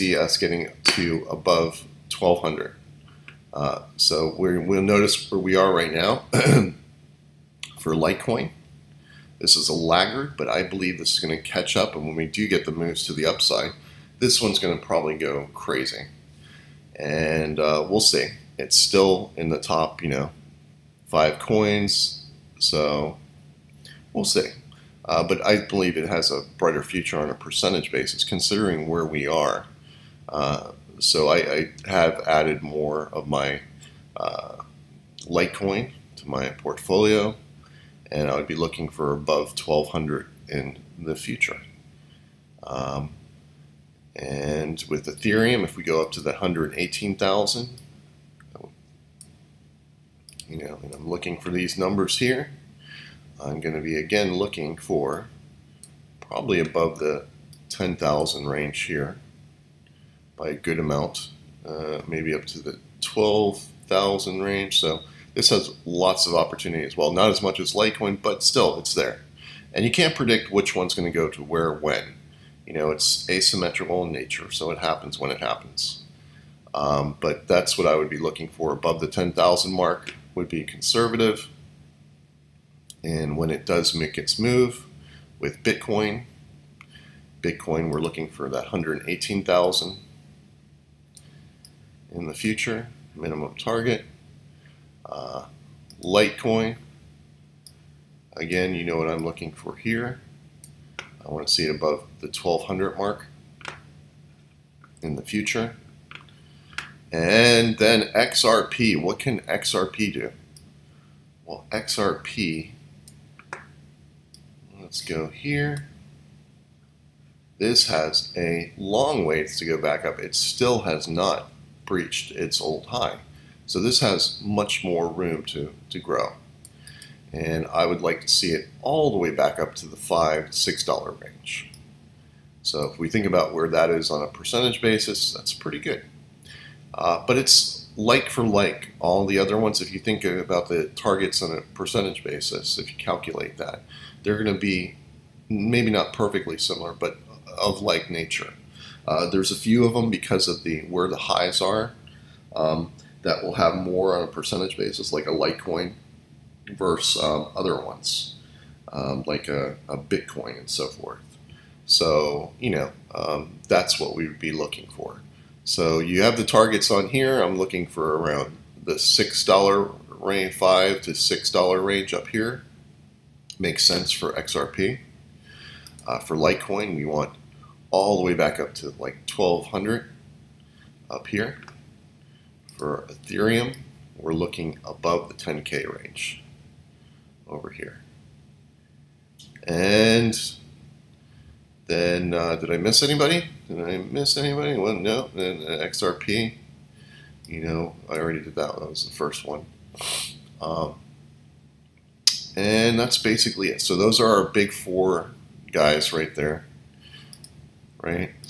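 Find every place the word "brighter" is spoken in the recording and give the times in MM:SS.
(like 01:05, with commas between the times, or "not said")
00:26.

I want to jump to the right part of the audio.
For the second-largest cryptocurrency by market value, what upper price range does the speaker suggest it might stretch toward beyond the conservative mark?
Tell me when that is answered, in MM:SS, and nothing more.
01:03.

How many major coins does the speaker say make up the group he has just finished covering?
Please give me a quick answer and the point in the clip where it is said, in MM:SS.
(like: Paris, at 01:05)
4, at 03:24.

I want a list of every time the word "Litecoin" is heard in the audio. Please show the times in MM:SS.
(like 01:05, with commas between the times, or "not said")
00:07, 00:35, 01:07, 01:36, 02:35, 02:56.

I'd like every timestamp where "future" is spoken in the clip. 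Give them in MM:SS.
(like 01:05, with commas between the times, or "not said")
00:26, 00:41, 01:32, 01:45.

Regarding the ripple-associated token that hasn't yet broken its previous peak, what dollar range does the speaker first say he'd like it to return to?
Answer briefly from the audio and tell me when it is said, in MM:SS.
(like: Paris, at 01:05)
5 to 6 dollars, at 02:09.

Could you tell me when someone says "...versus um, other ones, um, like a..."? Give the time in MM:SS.
02:36.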